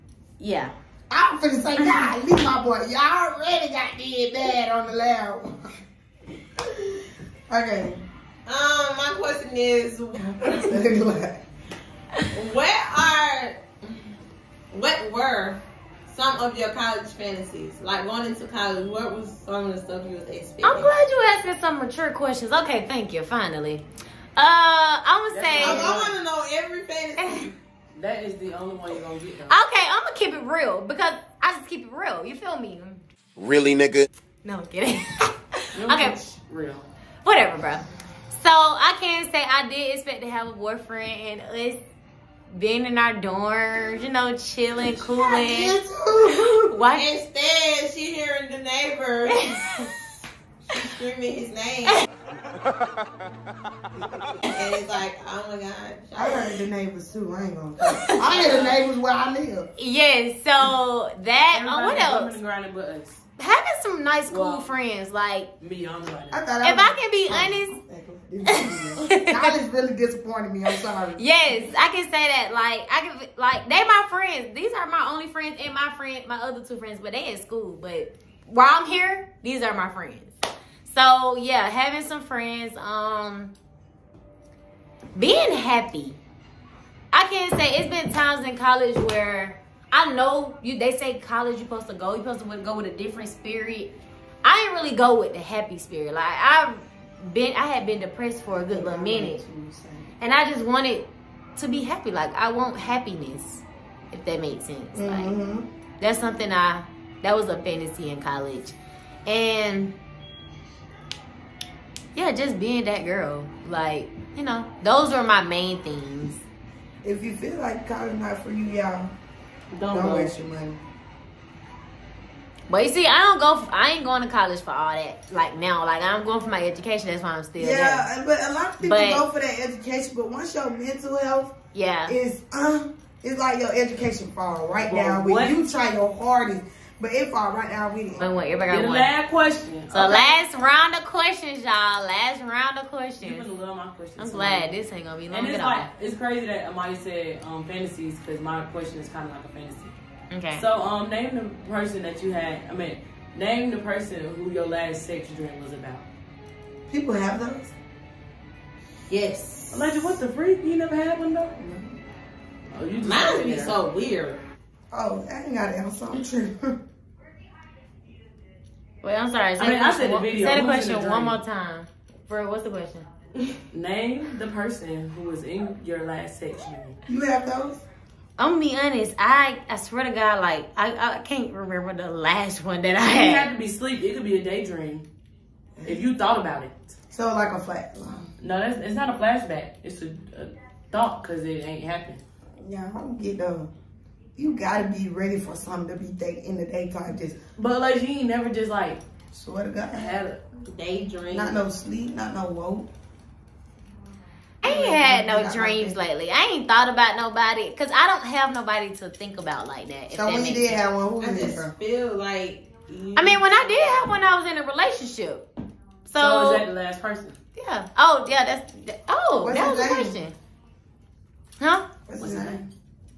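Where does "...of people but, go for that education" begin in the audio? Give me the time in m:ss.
2:08.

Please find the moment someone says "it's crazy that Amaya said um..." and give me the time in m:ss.
2:26.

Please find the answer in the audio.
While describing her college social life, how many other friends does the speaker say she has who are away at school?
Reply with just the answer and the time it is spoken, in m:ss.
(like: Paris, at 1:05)
2, at 1:16.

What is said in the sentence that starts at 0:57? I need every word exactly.
I hear the neighbors where I live.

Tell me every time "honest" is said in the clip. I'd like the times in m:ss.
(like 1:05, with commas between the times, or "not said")
1:08, 2:58.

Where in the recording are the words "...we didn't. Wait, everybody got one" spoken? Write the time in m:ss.
2:17.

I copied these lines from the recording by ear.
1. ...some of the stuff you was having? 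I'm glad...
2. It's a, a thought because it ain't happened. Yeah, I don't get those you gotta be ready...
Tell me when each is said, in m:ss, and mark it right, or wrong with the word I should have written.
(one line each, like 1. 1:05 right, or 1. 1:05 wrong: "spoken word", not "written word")
1. 0:19 wrong: "expecting", not "having"
2. 3:09 right.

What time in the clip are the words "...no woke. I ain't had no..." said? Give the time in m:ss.
3:22.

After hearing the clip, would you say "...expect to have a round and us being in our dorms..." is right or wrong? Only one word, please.
wrong.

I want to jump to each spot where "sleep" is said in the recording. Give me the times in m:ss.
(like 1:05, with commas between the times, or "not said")
3:03, 3:21.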